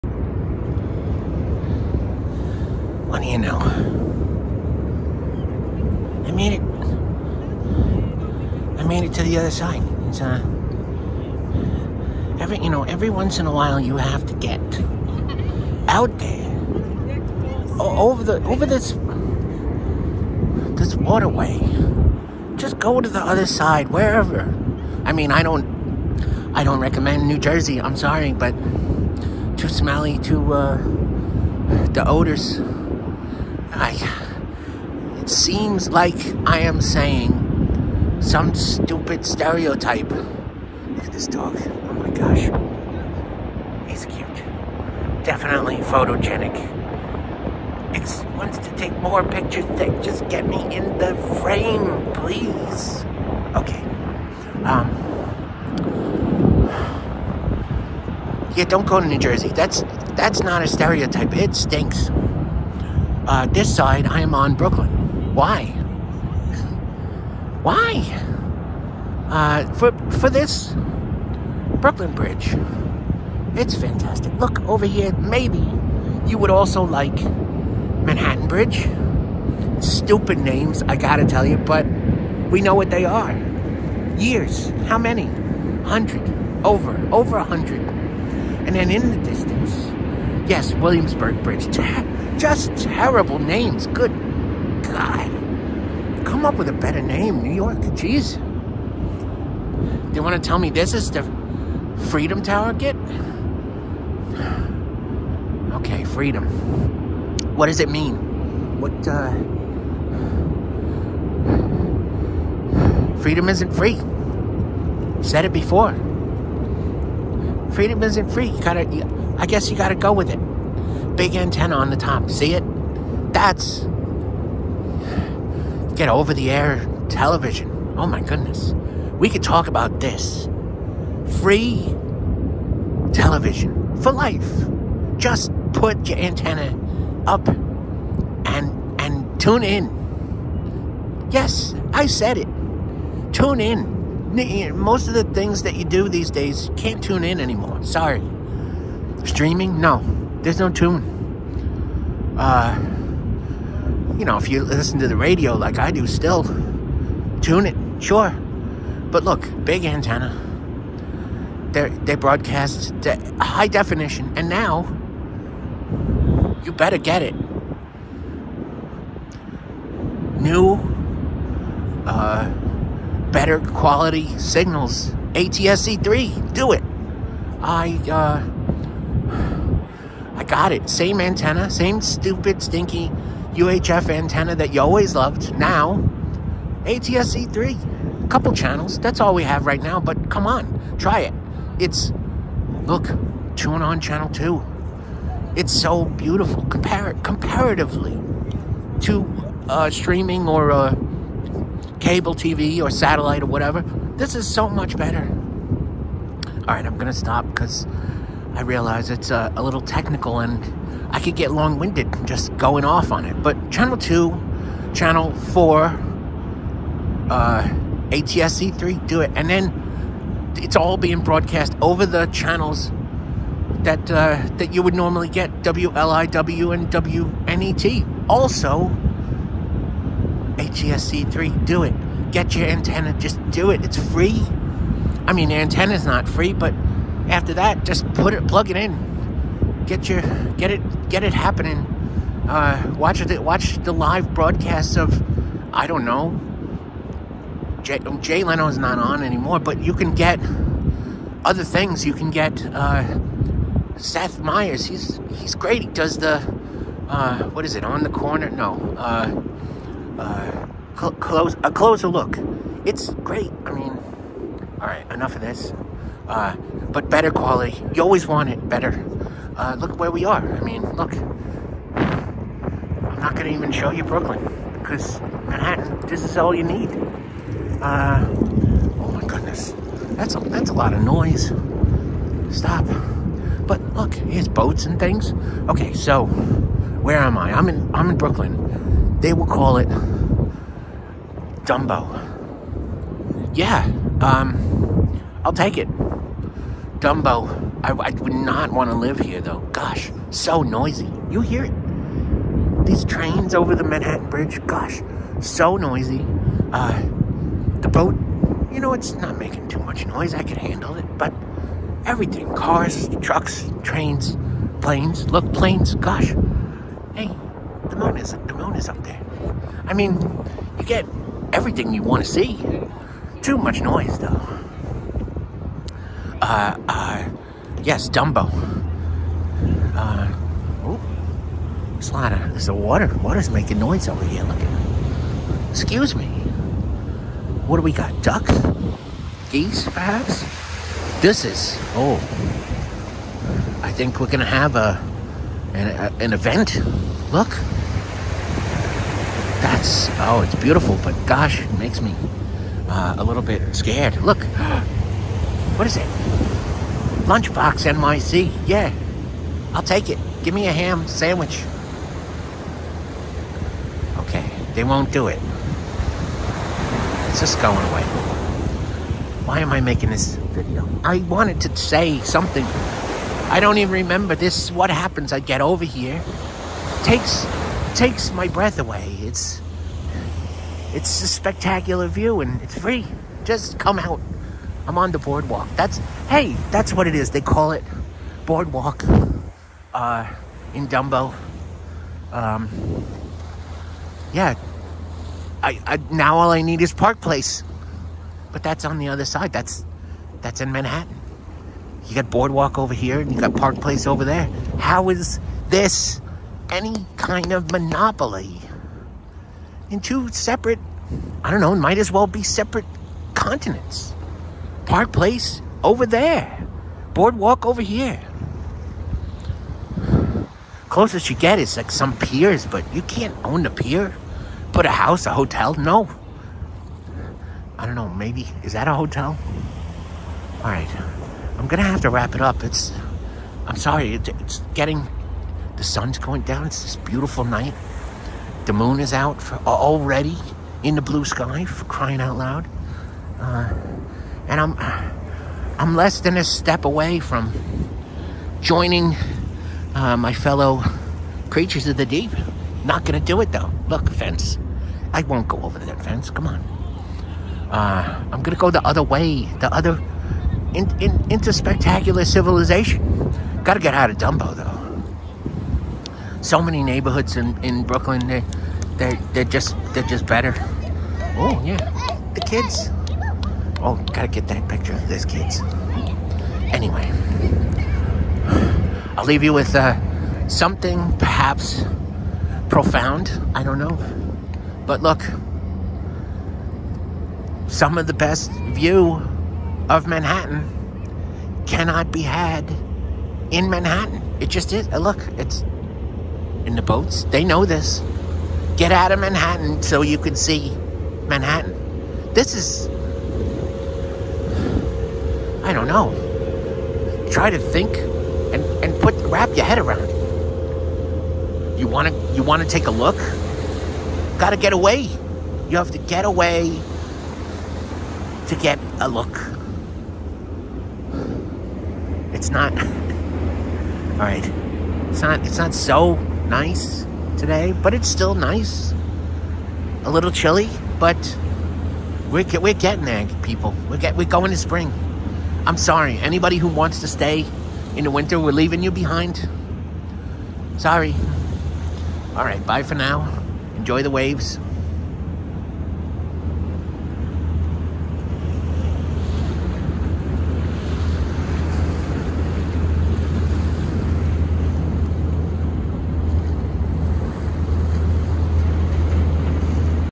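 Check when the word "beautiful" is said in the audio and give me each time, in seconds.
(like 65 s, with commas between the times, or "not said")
196 s, 350 s, 436 s.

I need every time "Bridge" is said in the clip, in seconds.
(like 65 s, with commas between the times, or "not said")
72 s, 78 s, 91 s, 304 s.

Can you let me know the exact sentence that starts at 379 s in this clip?
It's it's a spectacular view and it's free.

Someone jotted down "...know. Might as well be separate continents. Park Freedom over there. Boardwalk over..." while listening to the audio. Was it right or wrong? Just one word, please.
wrong.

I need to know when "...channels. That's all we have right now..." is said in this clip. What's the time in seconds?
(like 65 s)
188 s.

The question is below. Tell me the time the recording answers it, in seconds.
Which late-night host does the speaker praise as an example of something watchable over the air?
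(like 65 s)
253 s.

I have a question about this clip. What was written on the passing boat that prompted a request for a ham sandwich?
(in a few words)
Lunchbox NYC.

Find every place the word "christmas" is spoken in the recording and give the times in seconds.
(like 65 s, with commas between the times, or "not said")
not said.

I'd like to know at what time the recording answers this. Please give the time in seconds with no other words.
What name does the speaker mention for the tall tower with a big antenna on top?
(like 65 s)
102 s.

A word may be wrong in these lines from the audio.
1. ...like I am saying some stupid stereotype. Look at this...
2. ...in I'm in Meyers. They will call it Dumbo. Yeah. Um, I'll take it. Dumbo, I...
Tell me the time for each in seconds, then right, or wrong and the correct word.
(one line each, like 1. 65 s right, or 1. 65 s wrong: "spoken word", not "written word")
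1. 35 s right
2. 287 s wrong: "Brooklyn", not "Meyers".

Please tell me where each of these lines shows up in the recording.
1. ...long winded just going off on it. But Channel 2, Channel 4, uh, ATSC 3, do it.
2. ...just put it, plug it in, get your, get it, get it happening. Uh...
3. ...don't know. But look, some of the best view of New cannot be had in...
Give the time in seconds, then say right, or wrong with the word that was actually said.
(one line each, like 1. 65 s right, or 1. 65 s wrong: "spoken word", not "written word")
1. 211 s right
2. 237 s right
3. 483 s wrong: "Manhattan", not "New".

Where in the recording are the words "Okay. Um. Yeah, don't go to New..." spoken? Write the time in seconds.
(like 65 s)
53 s.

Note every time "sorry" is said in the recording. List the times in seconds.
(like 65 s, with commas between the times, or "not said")
27 s, 147 s, 433 s, 535 s, 540 s.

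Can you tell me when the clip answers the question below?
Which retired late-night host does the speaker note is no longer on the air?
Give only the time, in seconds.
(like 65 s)
248 s.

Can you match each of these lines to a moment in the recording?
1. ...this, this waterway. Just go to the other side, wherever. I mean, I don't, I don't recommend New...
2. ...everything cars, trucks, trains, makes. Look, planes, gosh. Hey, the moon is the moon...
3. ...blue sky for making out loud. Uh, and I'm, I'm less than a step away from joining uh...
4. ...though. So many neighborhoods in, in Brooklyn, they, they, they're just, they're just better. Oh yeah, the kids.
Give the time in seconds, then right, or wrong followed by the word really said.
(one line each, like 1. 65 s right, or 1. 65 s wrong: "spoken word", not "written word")
1. 18 s right
2. 312 s wrong: "planes", not "makes"
3. 441 s wrong: "crying", not "making"
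4. 464 s right.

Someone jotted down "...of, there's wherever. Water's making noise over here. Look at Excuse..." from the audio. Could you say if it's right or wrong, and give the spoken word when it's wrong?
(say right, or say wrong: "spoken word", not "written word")
wrong: "water", not "wherever".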